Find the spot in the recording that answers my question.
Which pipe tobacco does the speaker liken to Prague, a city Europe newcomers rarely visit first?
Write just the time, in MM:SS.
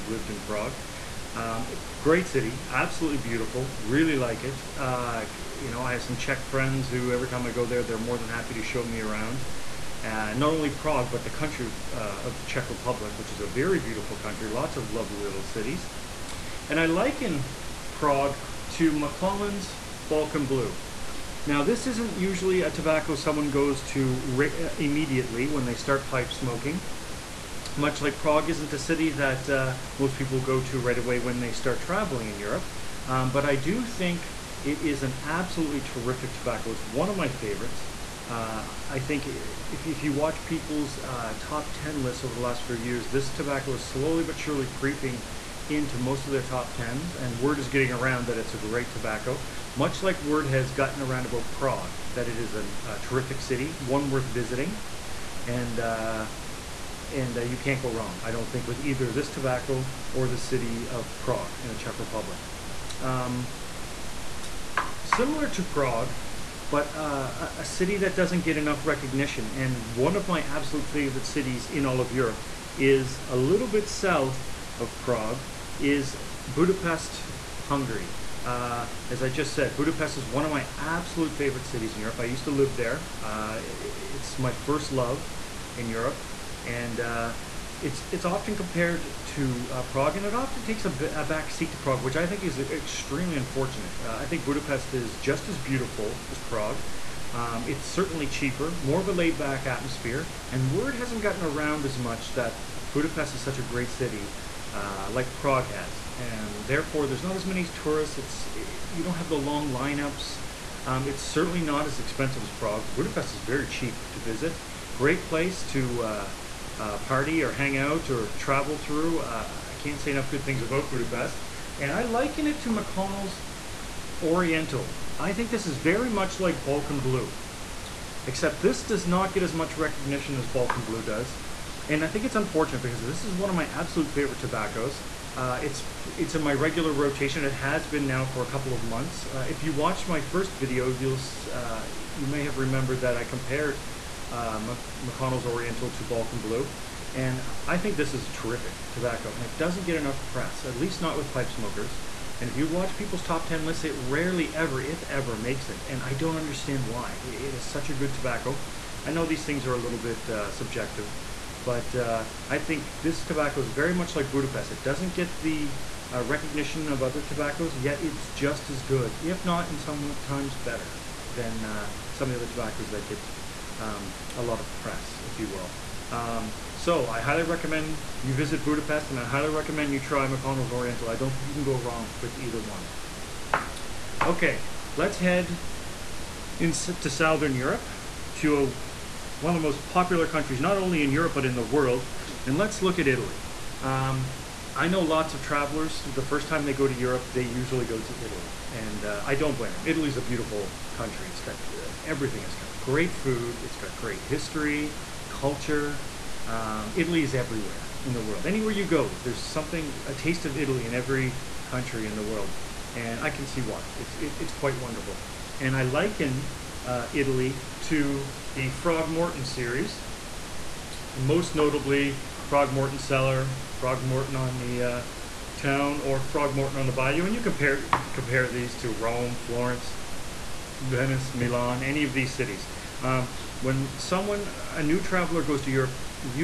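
00:18.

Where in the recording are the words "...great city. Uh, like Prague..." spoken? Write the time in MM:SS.
01:43.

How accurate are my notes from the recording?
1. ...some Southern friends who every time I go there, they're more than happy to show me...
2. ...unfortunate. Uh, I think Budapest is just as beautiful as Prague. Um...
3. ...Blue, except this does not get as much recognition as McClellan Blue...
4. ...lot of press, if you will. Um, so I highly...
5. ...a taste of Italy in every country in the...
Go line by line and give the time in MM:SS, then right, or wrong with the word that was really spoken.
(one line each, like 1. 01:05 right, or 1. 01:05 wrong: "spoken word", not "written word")
1. 00:06 wrong: "Czech", not "Southern"
2. 01:33 right
3. 02:06 wrong: "Balkan", not "McClellan"
4. 02:54 right
5. 03:30 right.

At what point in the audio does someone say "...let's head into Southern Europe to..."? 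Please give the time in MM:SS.
03:04.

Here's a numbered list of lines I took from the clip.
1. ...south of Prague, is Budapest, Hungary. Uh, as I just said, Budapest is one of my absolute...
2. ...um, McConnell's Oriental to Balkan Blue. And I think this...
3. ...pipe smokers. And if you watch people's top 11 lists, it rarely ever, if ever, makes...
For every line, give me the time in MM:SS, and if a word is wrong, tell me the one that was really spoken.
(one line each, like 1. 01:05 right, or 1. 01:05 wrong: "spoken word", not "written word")
1. 01:13 right
2. 02:24 right
3. 02:31 wrong: "10", not "11".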